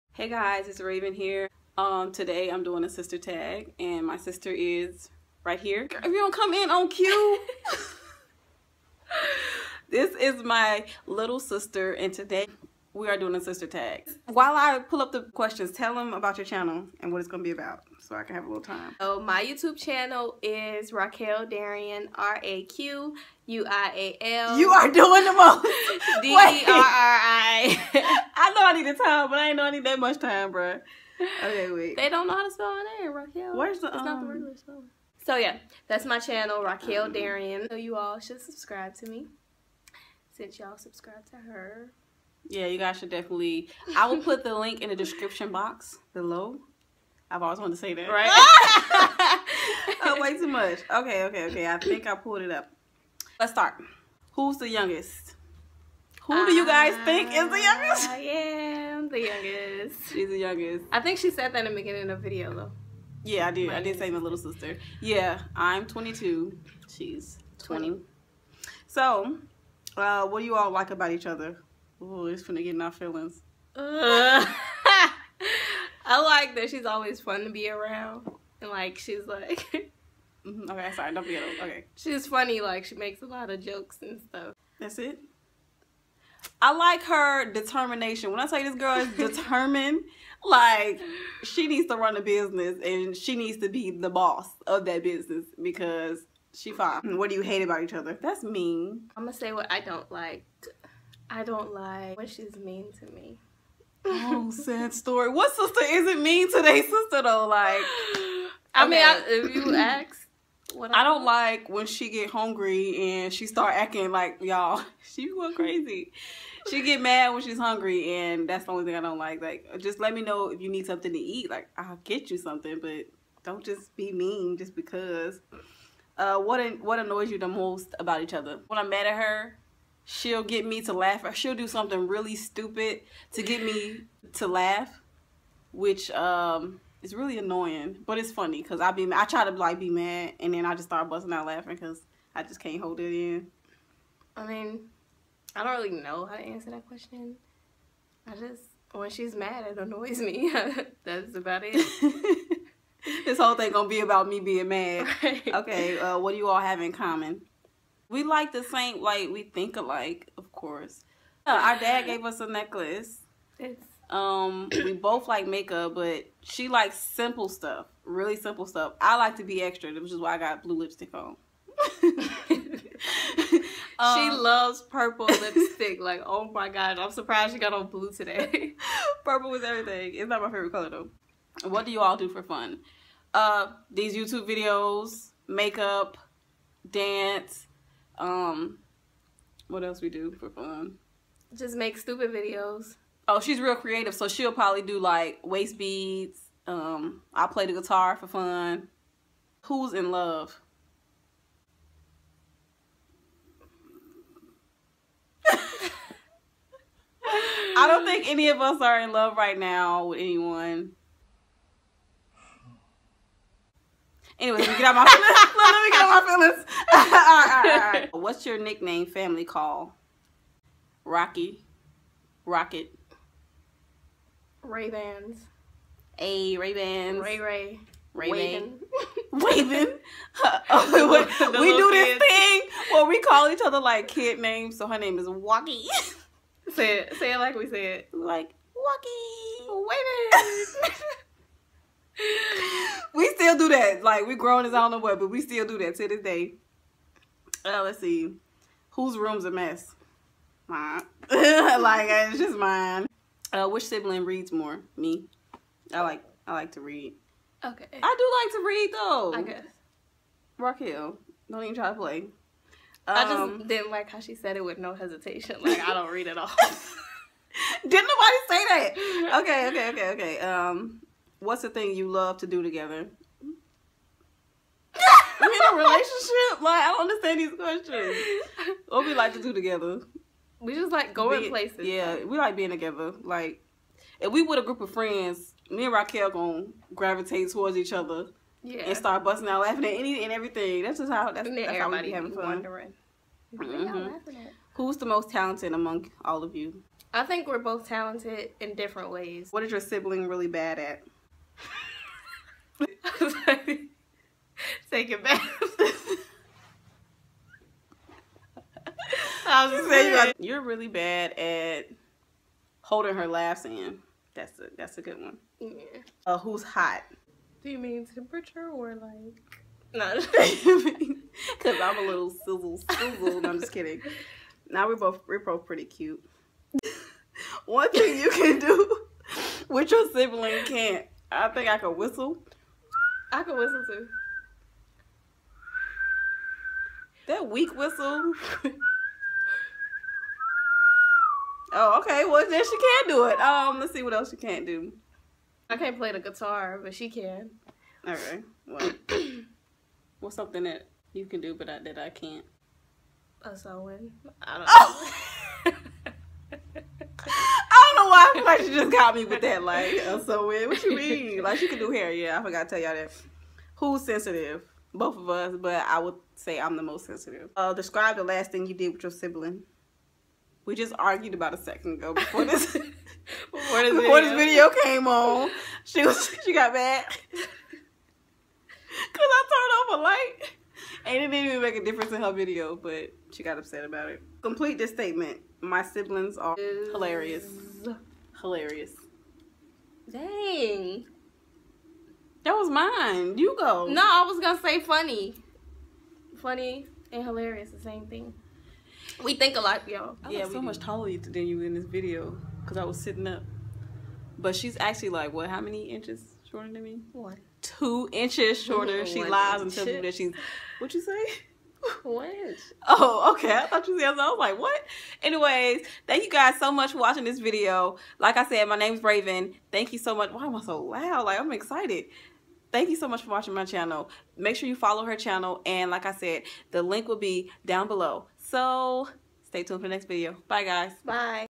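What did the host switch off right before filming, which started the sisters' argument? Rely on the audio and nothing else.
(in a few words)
a light.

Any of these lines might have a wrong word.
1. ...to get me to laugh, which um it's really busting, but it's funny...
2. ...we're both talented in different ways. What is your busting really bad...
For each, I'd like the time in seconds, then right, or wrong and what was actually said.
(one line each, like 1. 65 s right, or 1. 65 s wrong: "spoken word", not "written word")
1. 133 s wrong: "annoying", not "busting"
2. 297 s wrong: "sibling", not "busting".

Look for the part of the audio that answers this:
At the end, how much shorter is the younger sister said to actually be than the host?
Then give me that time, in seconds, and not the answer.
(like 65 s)
407 s.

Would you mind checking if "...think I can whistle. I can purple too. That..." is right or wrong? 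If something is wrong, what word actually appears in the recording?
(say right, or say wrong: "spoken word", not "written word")
wrong: "whistle", not "purple".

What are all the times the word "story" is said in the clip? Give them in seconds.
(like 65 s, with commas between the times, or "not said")
104 s.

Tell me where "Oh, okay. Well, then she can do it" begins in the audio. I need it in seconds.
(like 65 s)
341 s.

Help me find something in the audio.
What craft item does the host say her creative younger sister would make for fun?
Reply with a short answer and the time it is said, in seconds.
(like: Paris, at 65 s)
waist beads, at 195 s.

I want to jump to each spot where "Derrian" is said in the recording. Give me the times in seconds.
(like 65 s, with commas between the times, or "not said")
21 s, 37 s.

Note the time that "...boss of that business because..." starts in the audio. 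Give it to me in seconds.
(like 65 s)
94 s.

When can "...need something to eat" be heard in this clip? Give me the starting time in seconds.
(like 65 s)
120 s.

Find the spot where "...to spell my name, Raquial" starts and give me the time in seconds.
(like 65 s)
32 s.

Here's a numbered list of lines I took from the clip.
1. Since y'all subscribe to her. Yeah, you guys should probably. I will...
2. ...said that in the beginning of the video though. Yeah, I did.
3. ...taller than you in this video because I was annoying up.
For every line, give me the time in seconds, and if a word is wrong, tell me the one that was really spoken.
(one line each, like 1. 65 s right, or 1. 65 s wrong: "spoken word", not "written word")
1. 40 s wrong: "definitely", not "probably"
2. 61 s right
3. 400 s wrong: "sitting", not "annoying".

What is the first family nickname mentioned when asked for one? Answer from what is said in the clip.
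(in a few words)
Rocky.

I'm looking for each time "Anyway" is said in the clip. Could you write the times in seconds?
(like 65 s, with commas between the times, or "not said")
214 s, 415 s.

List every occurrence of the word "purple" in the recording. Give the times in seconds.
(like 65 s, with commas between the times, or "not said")
174 s, 179 s.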